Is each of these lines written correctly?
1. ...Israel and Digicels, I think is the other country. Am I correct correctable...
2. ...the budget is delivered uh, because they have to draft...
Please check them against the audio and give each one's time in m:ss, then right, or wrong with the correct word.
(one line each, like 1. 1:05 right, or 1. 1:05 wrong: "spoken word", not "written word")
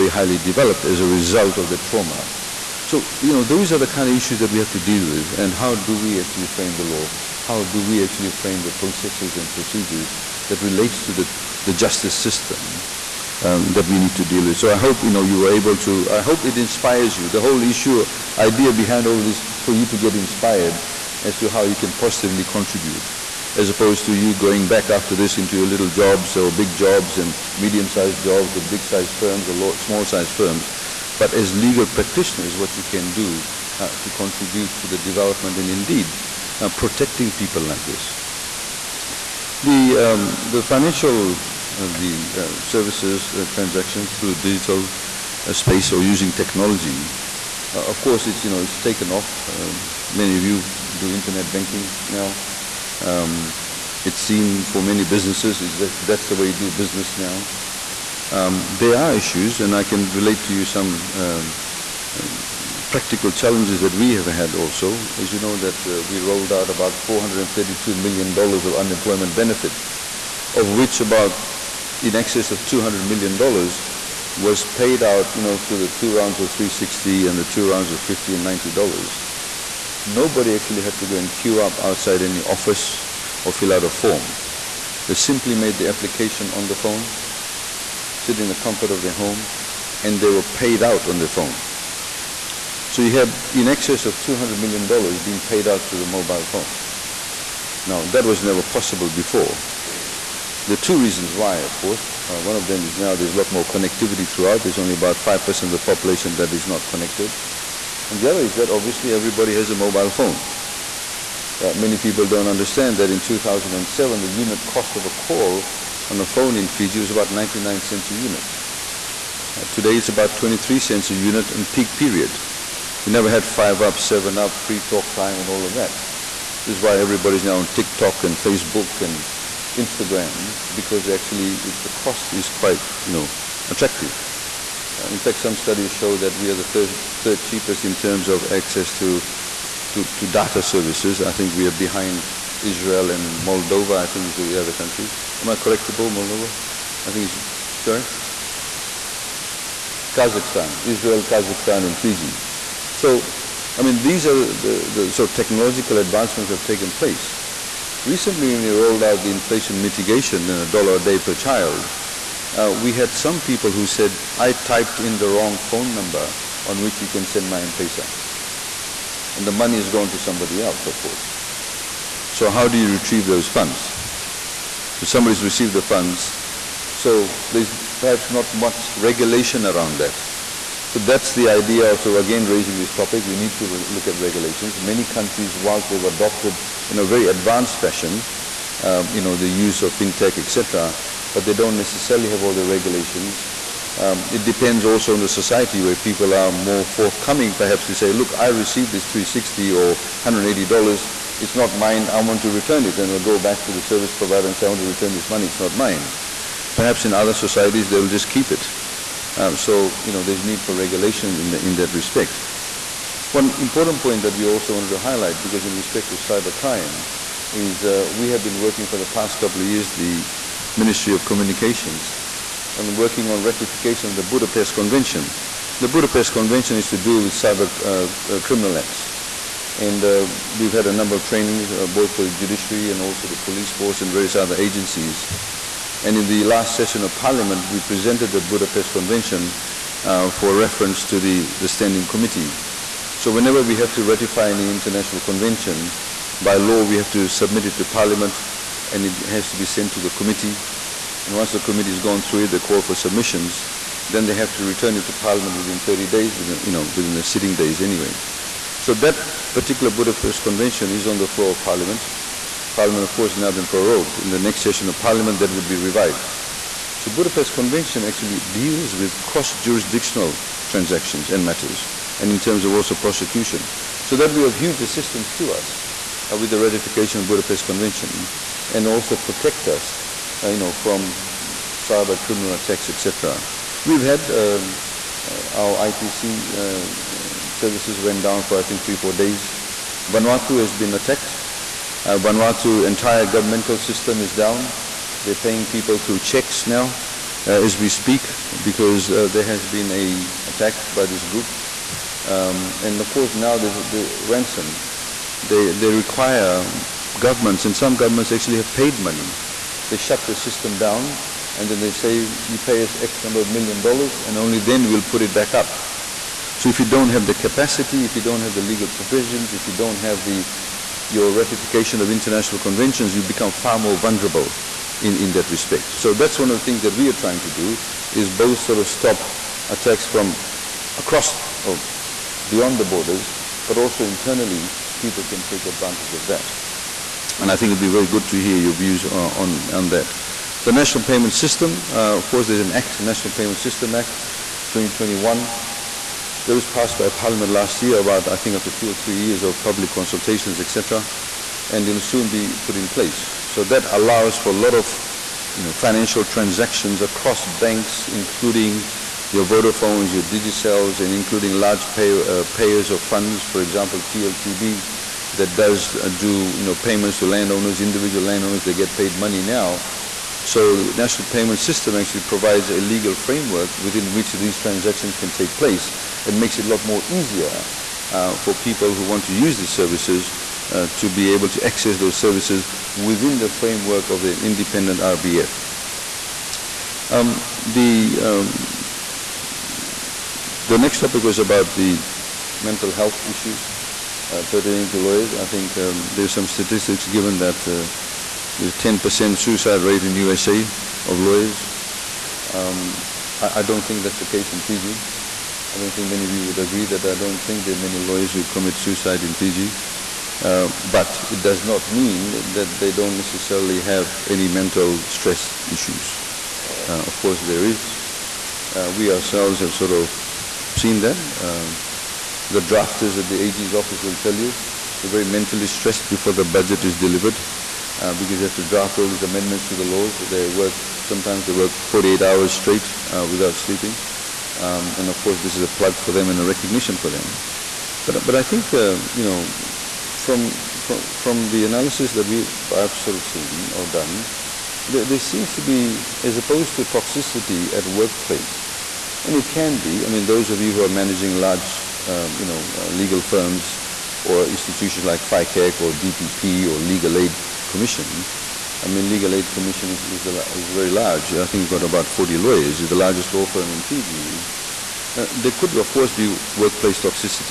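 1. 2:22 wrong: "Moldova", not "Digicels"
2. 7:06 right.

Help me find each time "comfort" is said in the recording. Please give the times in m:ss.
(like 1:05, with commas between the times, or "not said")
1:28.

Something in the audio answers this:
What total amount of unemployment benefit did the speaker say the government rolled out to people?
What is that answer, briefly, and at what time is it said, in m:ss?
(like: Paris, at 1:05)
$432 million, at 1:07.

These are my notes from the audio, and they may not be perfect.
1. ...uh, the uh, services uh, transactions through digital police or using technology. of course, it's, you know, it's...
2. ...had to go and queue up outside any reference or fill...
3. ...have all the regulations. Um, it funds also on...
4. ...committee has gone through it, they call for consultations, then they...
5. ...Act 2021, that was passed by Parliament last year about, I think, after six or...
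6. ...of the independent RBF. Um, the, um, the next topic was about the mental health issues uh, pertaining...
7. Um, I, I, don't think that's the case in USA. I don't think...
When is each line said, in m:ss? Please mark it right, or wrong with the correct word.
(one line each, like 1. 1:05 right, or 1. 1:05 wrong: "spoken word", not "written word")
1. 0:41 wrong: "space", not "police"
2. 1:20 wrong: "office", not "reference"
3. 3:12 wrong: "depends", not "funds"
4. 4:11 wrong: "submissions", not "consultations"
5. 5:43 wrong: "two", not "six"
6. 6:24 right
7. 6:42 wrong: "Fiji", not "USA".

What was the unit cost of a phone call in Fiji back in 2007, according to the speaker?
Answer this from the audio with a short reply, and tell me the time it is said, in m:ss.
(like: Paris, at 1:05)
99 cents, at 1:57.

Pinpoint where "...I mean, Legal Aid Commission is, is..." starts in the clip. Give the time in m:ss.
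7:38.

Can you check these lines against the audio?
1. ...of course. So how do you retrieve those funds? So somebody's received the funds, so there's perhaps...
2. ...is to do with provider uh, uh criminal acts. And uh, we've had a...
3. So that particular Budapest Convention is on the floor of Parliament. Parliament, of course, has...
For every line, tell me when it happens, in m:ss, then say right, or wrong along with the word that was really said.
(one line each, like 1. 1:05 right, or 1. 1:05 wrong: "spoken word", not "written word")
1. 2:50 right
2. 3:46 wrong: "cyber", not "provider"
3. 4:18 right.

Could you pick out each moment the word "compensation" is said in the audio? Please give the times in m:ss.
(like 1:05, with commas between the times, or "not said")
not said.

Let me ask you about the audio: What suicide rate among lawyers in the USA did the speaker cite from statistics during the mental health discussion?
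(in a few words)
10%.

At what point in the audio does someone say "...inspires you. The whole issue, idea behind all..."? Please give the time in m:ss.
0:16.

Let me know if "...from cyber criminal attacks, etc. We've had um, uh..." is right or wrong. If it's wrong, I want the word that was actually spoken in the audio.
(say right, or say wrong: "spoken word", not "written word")
right.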